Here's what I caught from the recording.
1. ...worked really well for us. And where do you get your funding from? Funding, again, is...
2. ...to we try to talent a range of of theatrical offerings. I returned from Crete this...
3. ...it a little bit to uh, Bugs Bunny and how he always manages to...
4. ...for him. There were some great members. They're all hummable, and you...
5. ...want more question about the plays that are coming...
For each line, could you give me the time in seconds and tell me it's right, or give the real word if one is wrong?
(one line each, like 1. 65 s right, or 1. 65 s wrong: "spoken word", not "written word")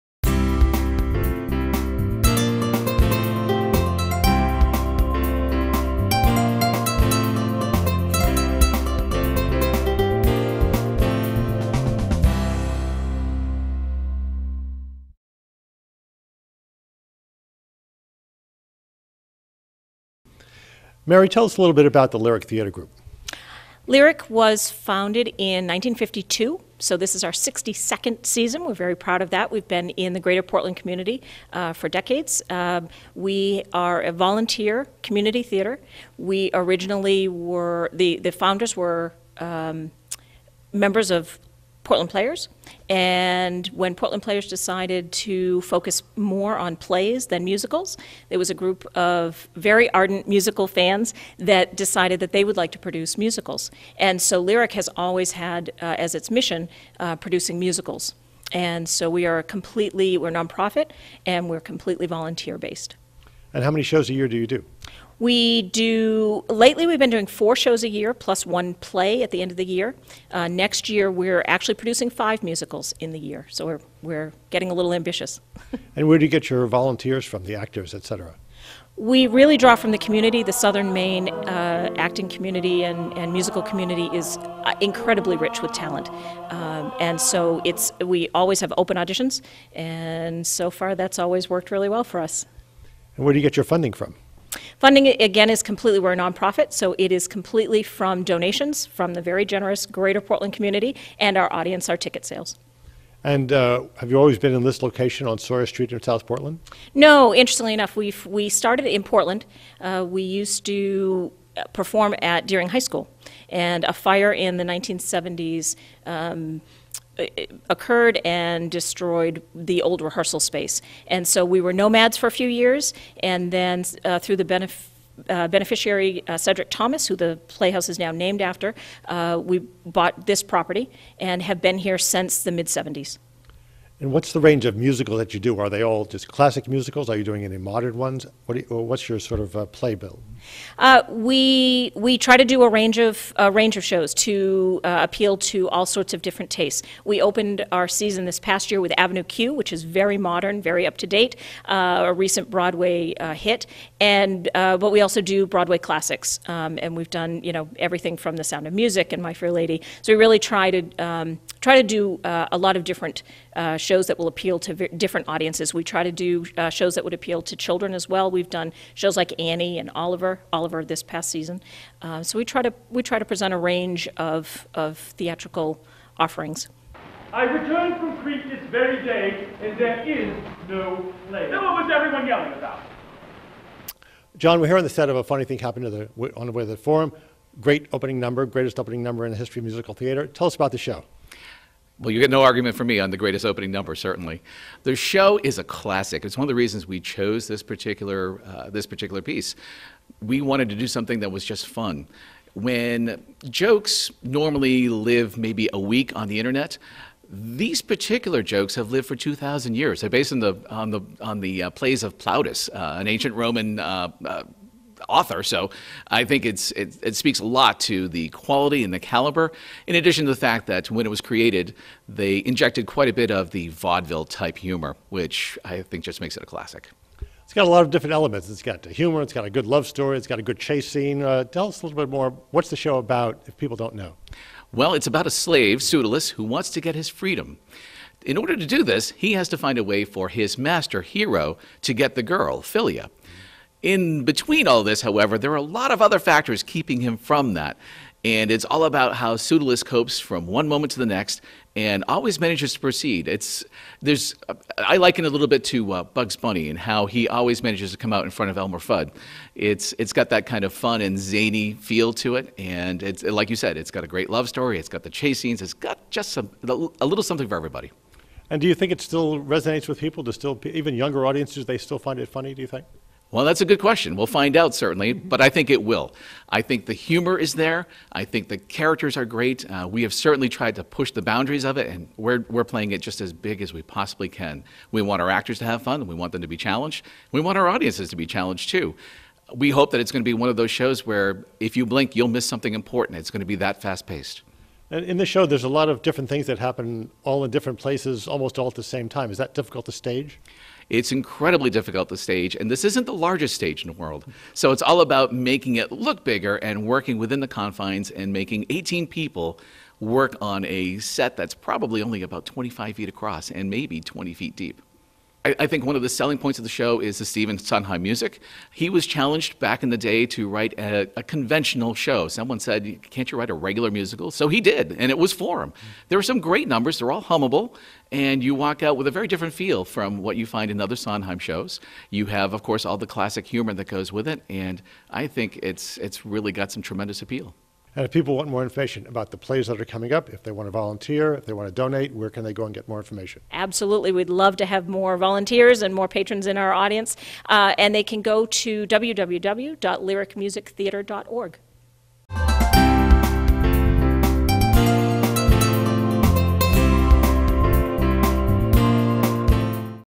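1. 91 s right
2. 172 s wrong: "present", not "talent"
3. 255 s right
4. 325 s wrong: "numbers", not "members"
5. 338 s wrong: "information", not "question".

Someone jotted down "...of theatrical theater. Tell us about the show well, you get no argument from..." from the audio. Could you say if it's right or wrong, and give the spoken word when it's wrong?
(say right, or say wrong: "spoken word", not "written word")
wrong: "musical", not "theatrical".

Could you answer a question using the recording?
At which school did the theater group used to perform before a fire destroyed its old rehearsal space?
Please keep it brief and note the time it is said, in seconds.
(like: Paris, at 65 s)
Deering High School, at 112 s.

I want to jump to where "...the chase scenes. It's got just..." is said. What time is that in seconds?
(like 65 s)
265 s.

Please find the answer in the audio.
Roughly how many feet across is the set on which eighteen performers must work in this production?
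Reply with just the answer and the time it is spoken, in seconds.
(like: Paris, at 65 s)
25 feet, at 312 s.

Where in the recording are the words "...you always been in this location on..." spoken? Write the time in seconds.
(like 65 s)
104 s.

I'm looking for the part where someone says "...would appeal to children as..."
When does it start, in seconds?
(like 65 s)
167 s.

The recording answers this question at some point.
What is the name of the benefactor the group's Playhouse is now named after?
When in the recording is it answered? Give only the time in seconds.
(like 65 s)
126 s.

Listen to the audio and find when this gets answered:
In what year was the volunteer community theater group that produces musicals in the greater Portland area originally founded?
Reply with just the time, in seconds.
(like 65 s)
25 s.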